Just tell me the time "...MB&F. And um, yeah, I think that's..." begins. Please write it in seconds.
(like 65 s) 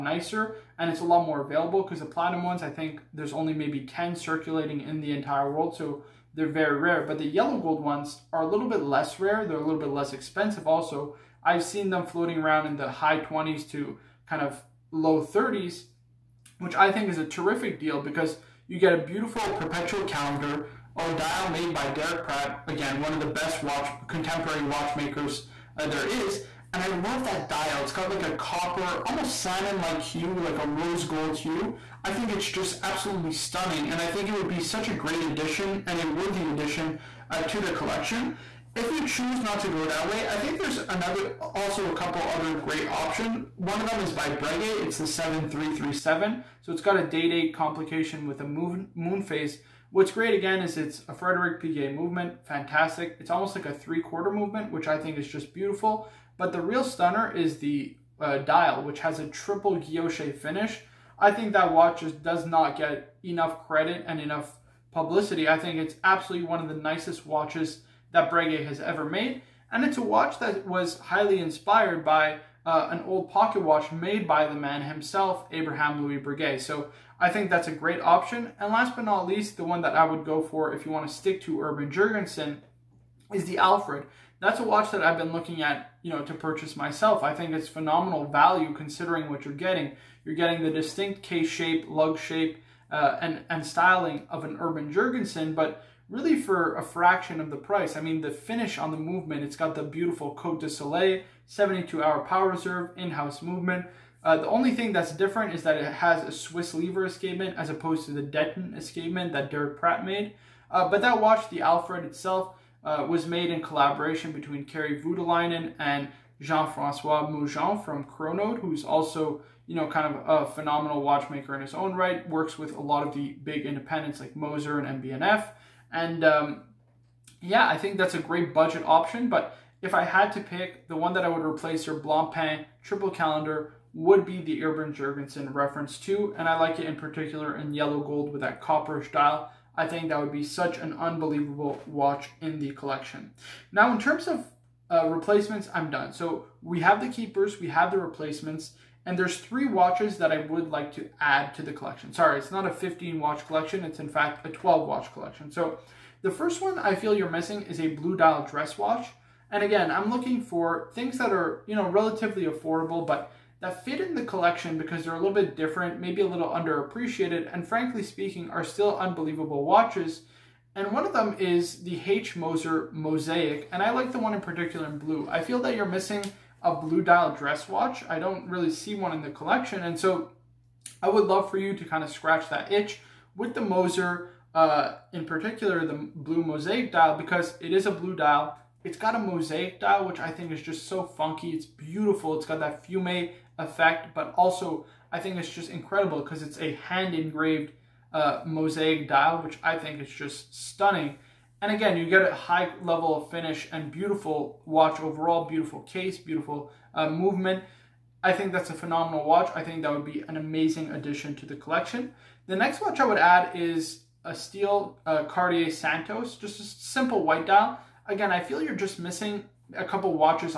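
125 s.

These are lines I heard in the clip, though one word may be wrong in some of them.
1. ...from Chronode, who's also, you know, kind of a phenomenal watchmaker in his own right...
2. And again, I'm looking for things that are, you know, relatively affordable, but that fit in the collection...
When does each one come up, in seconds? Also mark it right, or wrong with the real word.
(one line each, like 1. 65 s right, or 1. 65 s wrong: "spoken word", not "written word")
1. 117 s right
2. 159 s right.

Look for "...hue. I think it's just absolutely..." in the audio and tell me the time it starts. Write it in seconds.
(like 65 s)
31 s.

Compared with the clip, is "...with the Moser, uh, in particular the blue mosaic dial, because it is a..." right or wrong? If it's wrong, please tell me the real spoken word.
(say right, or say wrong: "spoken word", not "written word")
right.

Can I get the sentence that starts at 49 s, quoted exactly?
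What's great again is it's a Frederick Piguet movement.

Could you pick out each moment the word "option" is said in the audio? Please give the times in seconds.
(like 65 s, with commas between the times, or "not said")
42 s, 78 s, 128 s.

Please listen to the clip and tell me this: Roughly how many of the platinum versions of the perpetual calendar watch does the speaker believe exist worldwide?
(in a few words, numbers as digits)
10.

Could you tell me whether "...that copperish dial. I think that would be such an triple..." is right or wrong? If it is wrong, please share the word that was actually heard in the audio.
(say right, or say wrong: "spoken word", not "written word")
wrong: "unbelievable", not "triple".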